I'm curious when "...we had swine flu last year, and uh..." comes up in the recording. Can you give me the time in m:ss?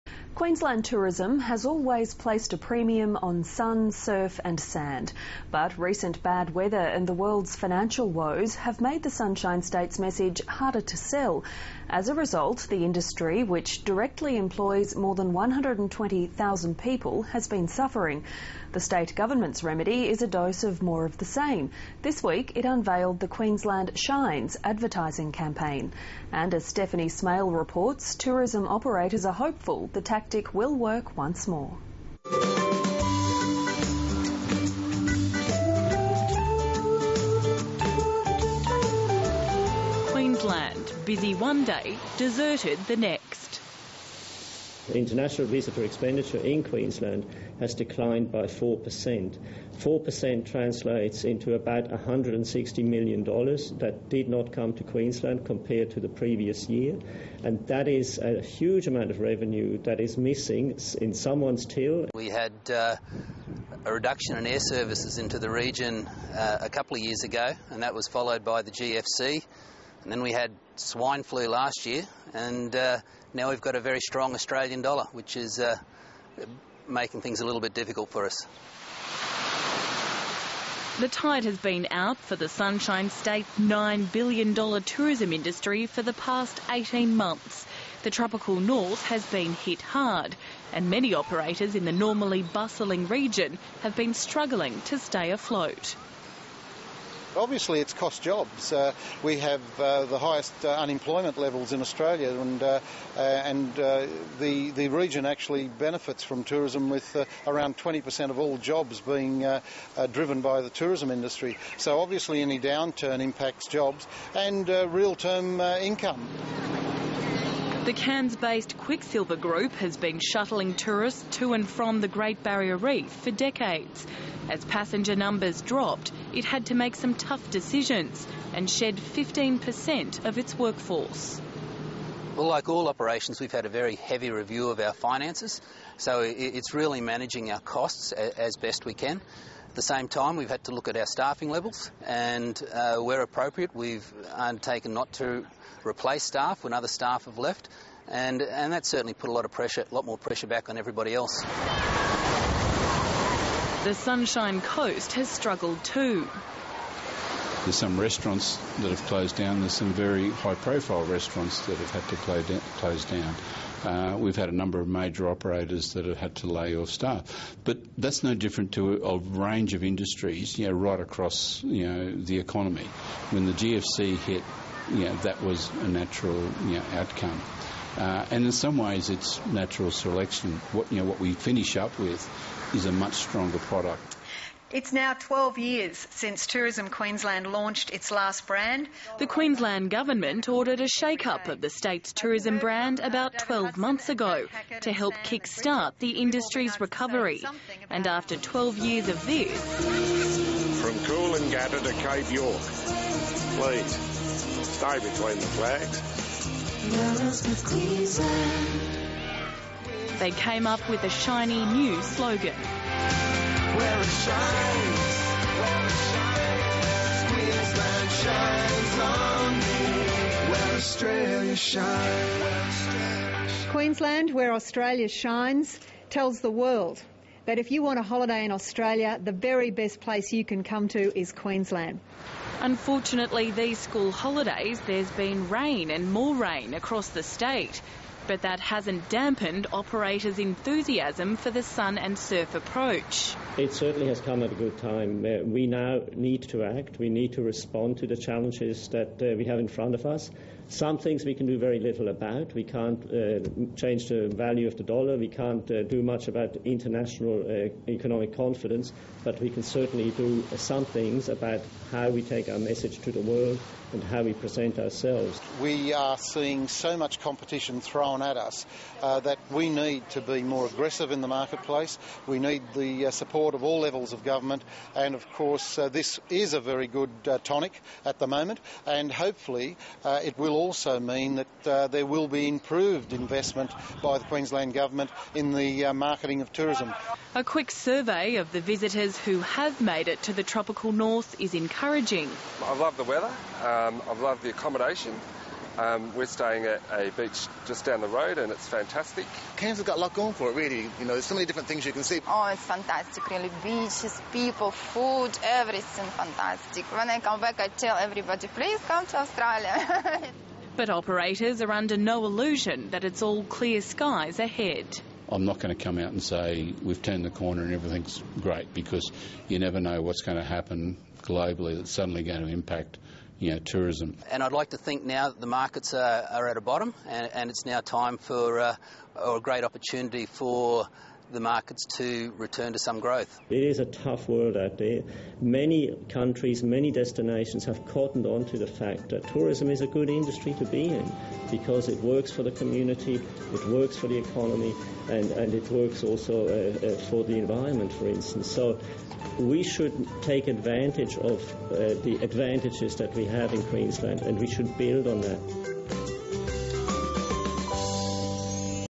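1:10.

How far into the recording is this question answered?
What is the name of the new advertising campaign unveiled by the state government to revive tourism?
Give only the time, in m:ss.
0:23.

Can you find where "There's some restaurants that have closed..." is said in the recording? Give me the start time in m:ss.
2:37.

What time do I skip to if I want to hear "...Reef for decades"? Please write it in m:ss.
2:02.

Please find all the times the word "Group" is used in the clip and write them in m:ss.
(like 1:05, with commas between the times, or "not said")
1:59.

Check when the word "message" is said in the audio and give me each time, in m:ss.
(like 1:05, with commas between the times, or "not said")
0:09, 4:22.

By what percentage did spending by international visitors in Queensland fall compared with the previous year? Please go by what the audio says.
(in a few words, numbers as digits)
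4%.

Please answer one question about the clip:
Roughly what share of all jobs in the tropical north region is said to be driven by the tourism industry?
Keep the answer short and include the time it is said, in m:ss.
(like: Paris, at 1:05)
20%, at 1:47.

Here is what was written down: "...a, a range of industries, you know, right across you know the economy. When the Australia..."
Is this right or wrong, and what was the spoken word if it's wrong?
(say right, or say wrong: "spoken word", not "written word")
wrong: "GFC", not "Australia".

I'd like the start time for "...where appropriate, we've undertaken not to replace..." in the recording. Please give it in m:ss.
2:22.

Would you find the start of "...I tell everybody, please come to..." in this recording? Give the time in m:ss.
5:07.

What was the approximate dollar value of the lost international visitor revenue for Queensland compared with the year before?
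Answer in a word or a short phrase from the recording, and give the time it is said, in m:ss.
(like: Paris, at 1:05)
$160 million, at 0:51.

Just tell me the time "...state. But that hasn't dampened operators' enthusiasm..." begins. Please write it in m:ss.
3:57.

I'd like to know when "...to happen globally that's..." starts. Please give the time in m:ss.
5:20.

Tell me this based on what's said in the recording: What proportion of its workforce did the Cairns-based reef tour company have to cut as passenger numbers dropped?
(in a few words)
15%.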